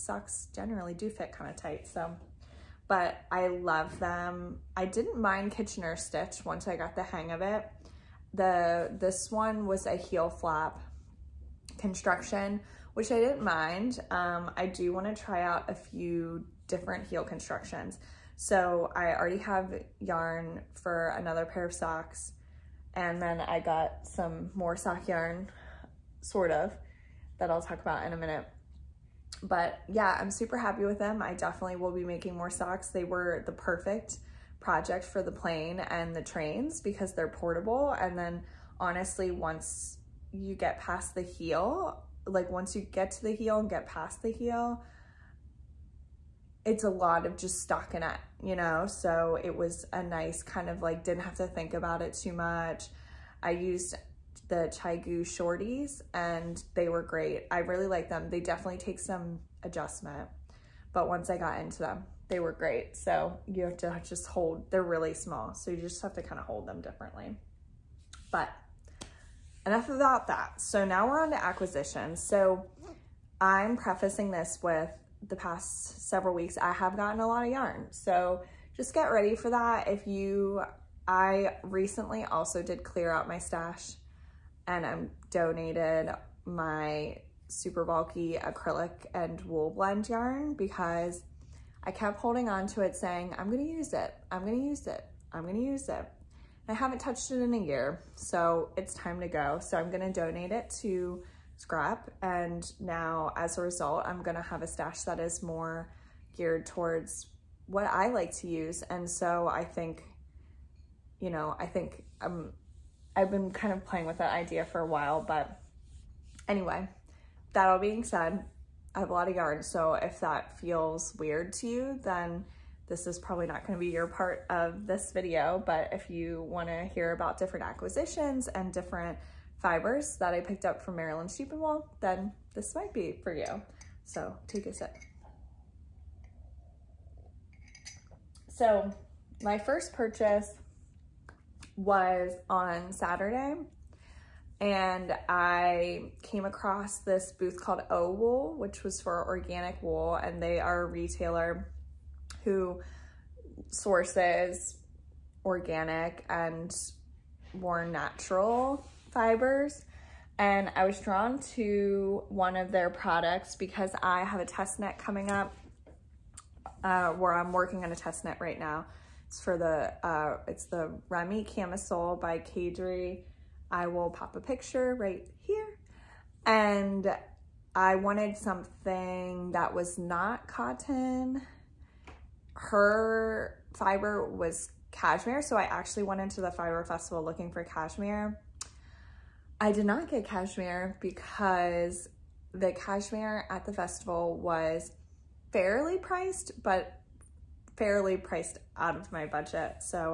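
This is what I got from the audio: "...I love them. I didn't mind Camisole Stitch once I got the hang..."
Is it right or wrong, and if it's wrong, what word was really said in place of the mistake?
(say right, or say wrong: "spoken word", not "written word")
wrong: "Kitchener", not "Camisole".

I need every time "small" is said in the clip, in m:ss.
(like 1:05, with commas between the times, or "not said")
1:05.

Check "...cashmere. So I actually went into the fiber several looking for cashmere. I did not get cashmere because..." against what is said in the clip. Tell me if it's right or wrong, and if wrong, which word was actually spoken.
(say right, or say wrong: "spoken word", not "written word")
wrong: "festival", not "several".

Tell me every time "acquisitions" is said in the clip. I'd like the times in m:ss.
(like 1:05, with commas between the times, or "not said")
1:11, 2:07.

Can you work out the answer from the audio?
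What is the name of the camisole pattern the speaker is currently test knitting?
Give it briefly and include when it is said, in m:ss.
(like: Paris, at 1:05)
Remi Camisole, at 2:51.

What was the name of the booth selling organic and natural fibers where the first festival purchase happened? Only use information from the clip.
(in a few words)
O Wool.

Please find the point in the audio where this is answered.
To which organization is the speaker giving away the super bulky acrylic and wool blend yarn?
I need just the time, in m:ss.
1:41.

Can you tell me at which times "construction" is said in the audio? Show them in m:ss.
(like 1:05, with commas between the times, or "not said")
0:11, 0:17.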